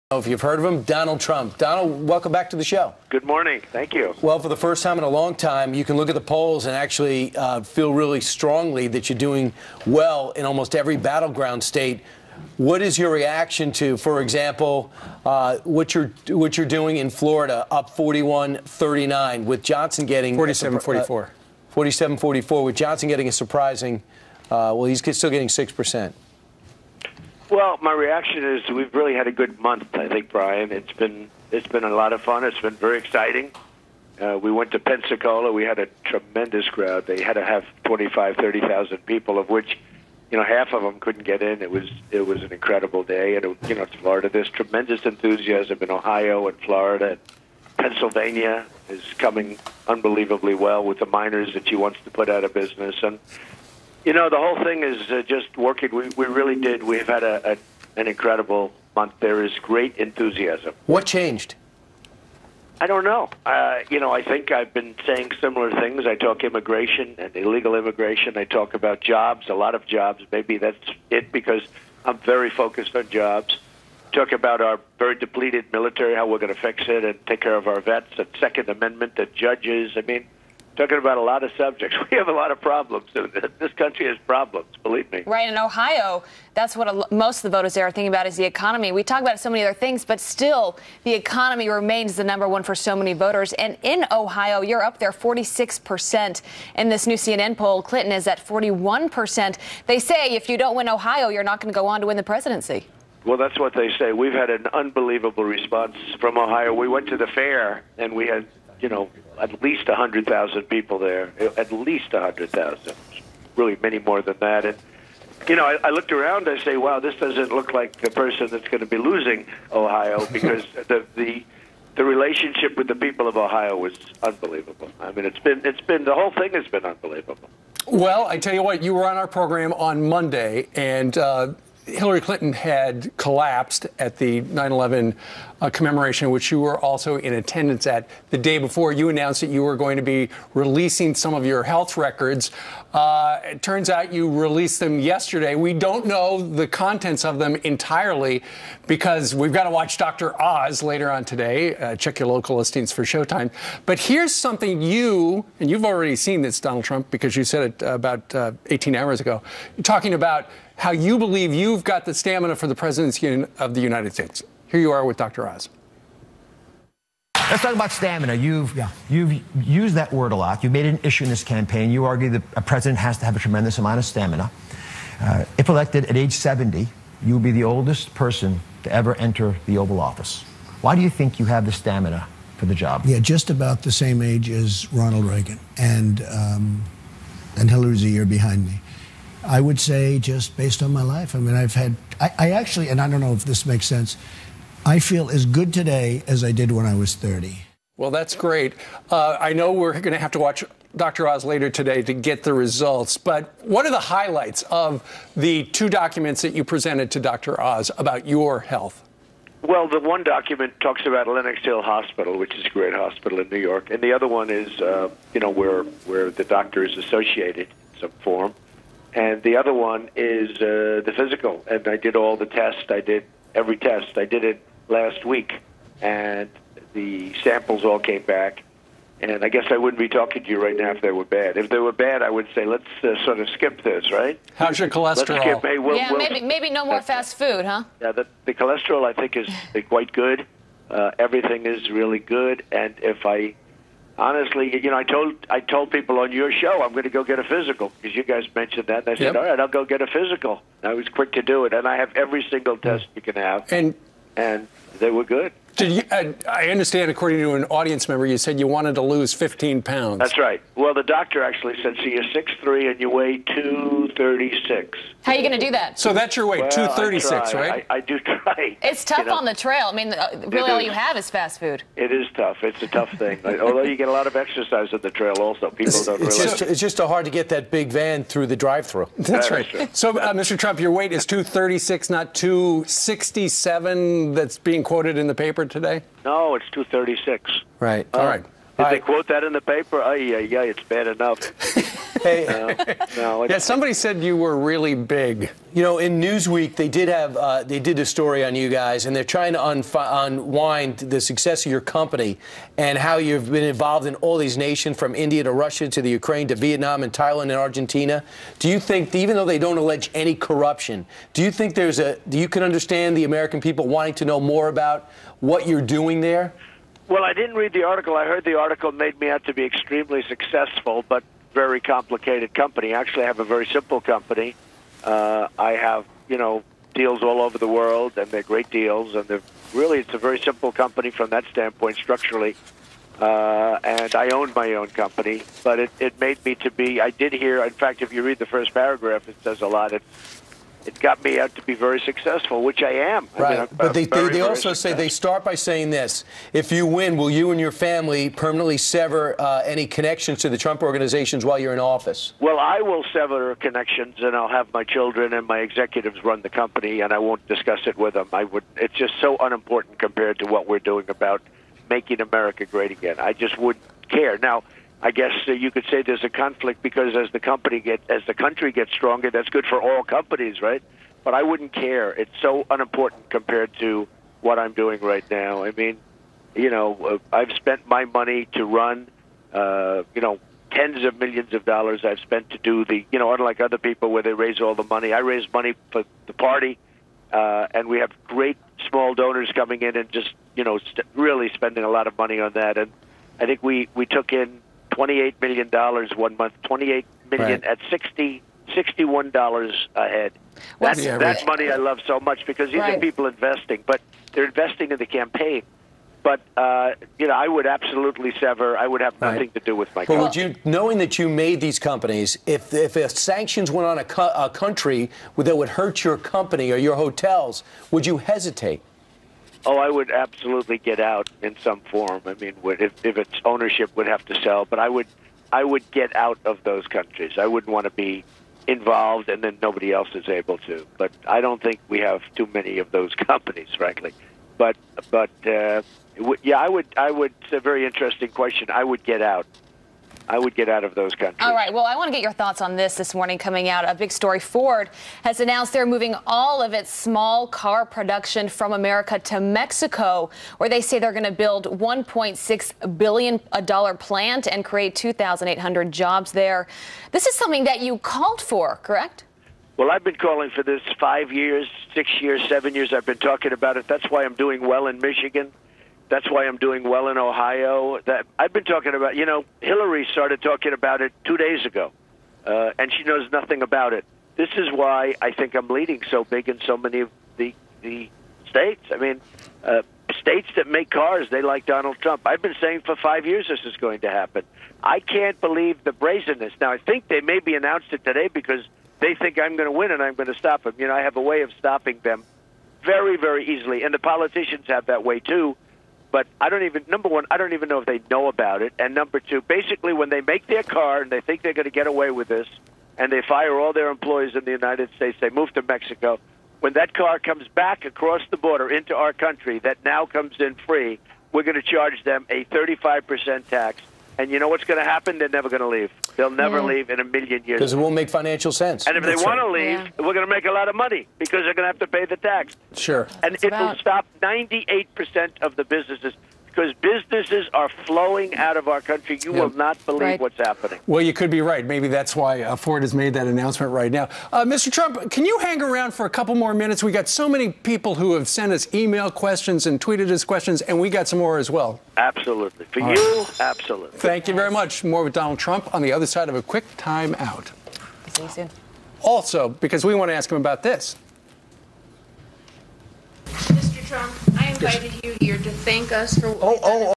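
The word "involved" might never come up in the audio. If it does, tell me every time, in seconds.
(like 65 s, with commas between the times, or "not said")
303 s, 428 s.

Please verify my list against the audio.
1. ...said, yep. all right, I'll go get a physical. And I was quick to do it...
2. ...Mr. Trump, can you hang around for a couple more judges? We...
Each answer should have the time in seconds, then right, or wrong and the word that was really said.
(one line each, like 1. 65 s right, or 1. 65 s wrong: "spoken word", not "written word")
1. 249 s right
2. 534 s wrong: "minutes", not "judges".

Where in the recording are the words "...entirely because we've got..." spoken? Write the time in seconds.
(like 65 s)
147 s.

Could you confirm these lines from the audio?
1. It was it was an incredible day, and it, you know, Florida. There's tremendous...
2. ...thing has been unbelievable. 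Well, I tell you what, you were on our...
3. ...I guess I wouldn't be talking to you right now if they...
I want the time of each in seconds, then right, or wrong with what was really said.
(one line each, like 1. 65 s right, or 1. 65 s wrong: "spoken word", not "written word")
1. 41 s right
2. 126 s right
3. 229 s right.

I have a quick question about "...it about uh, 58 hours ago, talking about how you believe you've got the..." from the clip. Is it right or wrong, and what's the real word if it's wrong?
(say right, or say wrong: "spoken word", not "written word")
wrong: "18", not "58".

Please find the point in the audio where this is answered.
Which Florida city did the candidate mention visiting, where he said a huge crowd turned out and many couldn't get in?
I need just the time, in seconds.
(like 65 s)
34 s.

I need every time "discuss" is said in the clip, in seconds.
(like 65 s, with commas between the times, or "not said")
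357 s.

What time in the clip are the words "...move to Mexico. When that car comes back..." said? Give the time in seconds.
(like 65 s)
505 s.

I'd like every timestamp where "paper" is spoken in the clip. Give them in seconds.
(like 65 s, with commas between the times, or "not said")
285 s, 289 s.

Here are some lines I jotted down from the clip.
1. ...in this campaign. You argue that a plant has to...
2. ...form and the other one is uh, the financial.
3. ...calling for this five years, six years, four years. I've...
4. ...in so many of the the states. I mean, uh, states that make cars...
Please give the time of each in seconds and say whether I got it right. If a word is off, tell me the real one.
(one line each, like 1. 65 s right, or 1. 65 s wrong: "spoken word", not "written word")
1. 171 s wrong: "president", not "plant"
2. 218 s wrong: "physical", not "financial"
3. 460 s wrong: "seven", not "four"
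4. 476 s right.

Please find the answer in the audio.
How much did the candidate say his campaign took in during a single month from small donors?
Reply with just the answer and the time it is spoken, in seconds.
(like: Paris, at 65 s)
$28 million, at 394 s.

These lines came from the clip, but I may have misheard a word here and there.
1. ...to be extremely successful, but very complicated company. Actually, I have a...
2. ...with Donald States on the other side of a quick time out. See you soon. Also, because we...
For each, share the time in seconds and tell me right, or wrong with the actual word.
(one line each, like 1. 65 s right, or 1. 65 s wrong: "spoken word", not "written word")
1. 319 s right
2. 545 s wrong: "Trump", not "States".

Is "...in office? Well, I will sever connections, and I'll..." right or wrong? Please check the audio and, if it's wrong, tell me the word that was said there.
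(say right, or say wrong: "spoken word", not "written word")
right.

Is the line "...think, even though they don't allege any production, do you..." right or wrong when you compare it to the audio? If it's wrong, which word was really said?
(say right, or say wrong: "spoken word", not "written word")
wrong: "corruption", not "production".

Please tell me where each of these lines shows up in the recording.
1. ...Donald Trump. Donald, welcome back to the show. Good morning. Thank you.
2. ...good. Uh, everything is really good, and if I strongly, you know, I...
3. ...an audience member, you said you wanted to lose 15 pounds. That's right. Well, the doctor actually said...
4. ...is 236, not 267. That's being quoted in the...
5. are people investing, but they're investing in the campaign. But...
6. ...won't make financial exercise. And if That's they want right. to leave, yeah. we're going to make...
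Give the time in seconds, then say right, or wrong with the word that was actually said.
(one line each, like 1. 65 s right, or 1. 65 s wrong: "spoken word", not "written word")
1. 0 s right
2. 240 s wrong: "honestly", not "strongly"
3. 257 s right
4. 281 s right
5. 402 s right
6. 517 s wrong: "sense", not "exercise".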